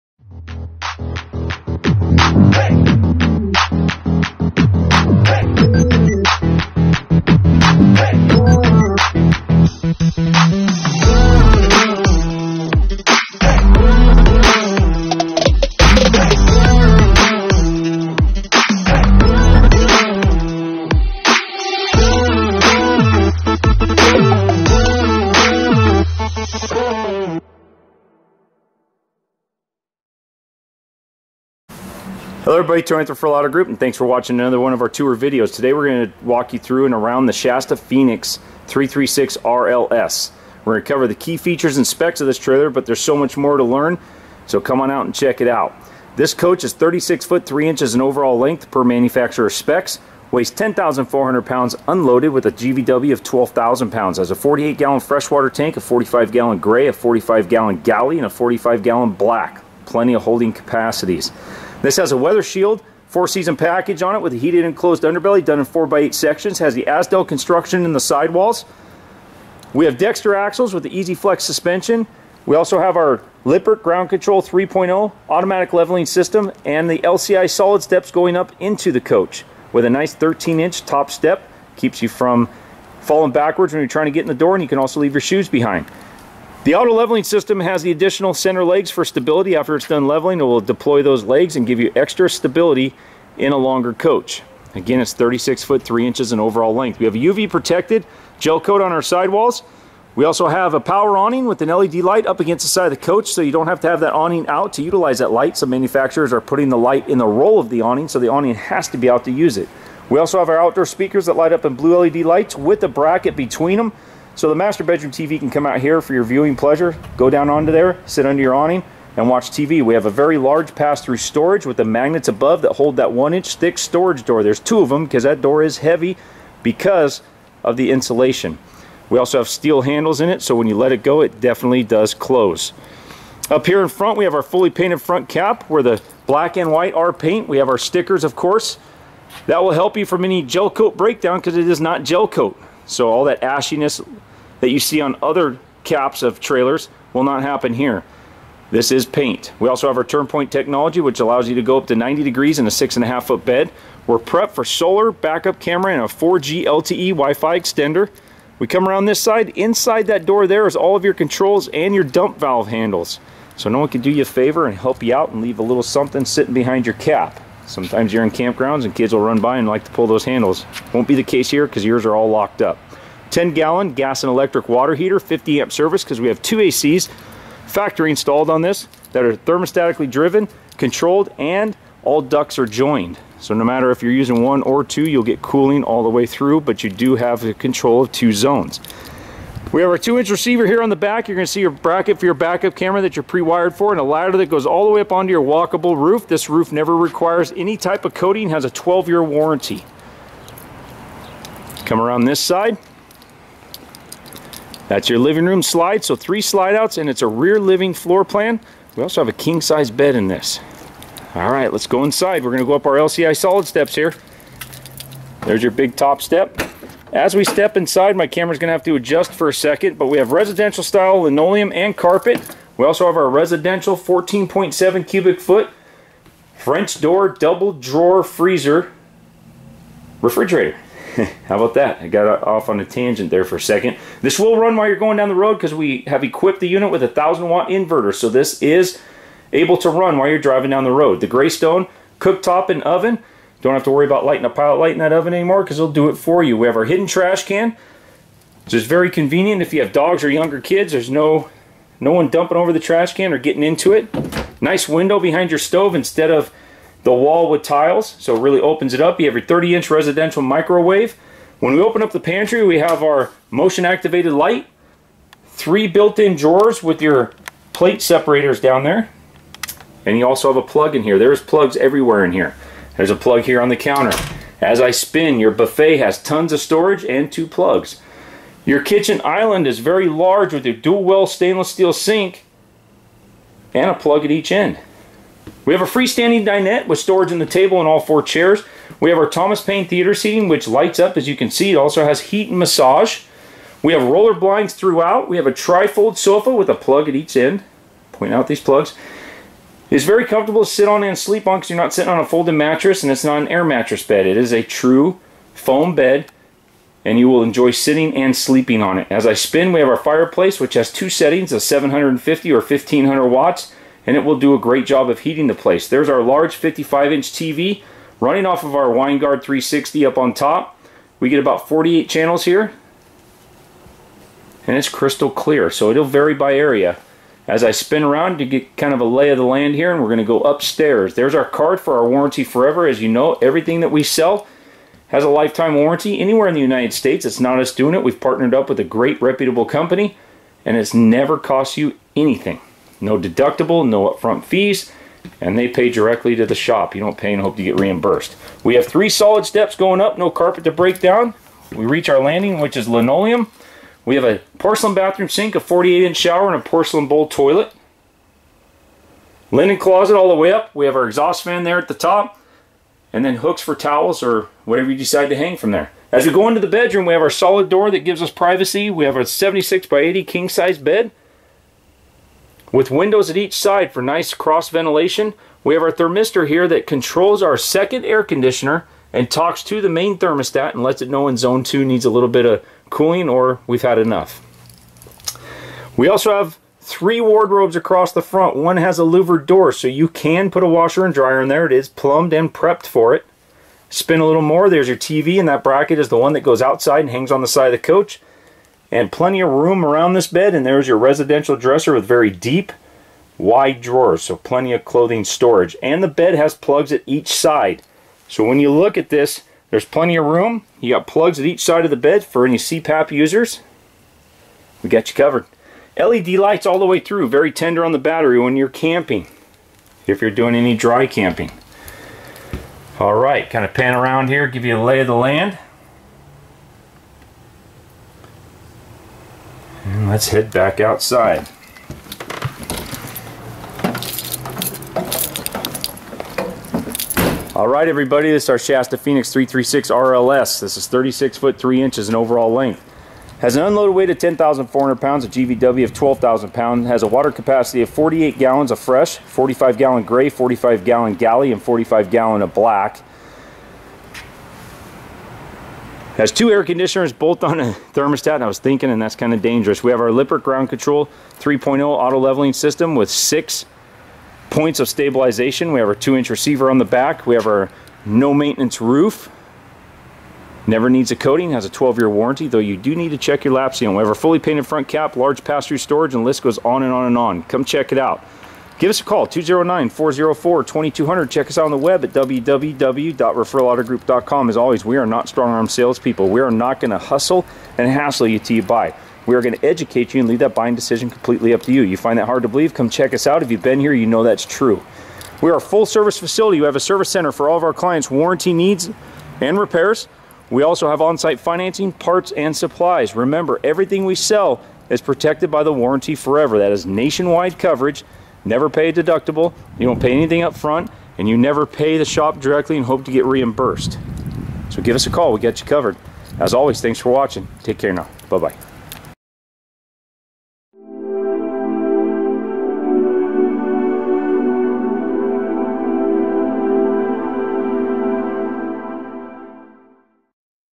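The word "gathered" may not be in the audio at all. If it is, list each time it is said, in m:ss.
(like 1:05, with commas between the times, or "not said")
not said.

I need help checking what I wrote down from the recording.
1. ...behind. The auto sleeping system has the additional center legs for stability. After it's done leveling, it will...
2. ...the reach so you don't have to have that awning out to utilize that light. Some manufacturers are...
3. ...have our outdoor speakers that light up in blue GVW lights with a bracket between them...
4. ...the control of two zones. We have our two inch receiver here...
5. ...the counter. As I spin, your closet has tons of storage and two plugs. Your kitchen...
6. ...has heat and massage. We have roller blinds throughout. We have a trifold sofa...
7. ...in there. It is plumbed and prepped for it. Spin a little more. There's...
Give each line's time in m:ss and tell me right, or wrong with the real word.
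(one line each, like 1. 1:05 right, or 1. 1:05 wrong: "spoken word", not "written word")
1. 1:25 wrong: "leveling", not "sleeping"
2. 1:42 wrong: "coach", not "reach"
3. 1:50 wrong: "LED", not "GVW"
4. 3:07 right
5. 4:33 wrong: "buffet", not "closet"
6. 4:52 right
7. 6:31 right.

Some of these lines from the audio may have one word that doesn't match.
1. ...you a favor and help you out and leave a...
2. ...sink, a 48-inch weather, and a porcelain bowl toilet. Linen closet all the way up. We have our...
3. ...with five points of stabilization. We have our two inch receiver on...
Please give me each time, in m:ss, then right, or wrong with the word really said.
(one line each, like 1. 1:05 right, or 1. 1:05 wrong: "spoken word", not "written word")
1. 2:44 right
2. 5:55 wrong: "shower", not "weather"
3. 7:42 wrong: "six", not "five".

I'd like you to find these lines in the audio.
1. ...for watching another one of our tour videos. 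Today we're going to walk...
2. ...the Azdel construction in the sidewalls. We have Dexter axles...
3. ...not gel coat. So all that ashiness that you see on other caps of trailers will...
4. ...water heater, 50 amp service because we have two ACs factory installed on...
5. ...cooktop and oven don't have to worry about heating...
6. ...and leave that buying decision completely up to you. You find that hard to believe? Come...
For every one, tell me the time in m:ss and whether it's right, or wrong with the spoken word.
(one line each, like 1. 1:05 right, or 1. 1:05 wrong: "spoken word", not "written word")
1. 0:33 right
2. 1:06 right
3. 2:21 right
4. 2:54 right
5. 4:02 wrong: "lighting", not "heating"
6. 8:10 right.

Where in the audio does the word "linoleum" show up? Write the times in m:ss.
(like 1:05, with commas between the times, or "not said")
3:41, 5:52.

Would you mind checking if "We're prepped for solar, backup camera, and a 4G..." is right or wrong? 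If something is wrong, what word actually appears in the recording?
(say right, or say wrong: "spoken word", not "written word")
right.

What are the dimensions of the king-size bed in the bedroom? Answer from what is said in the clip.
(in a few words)
76 by 80.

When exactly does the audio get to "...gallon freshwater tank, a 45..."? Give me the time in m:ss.
0:54.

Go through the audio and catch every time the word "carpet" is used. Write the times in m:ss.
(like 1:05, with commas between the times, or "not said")
3:41, 5:50.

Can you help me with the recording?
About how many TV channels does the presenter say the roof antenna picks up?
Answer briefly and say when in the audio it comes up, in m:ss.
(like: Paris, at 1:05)
48, at 5:21.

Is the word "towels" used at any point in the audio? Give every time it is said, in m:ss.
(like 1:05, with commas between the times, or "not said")
6:03.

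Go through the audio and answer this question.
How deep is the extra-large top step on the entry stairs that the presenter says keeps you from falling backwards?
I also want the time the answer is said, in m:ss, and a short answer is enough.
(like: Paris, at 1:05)
13 inches, at 1:20.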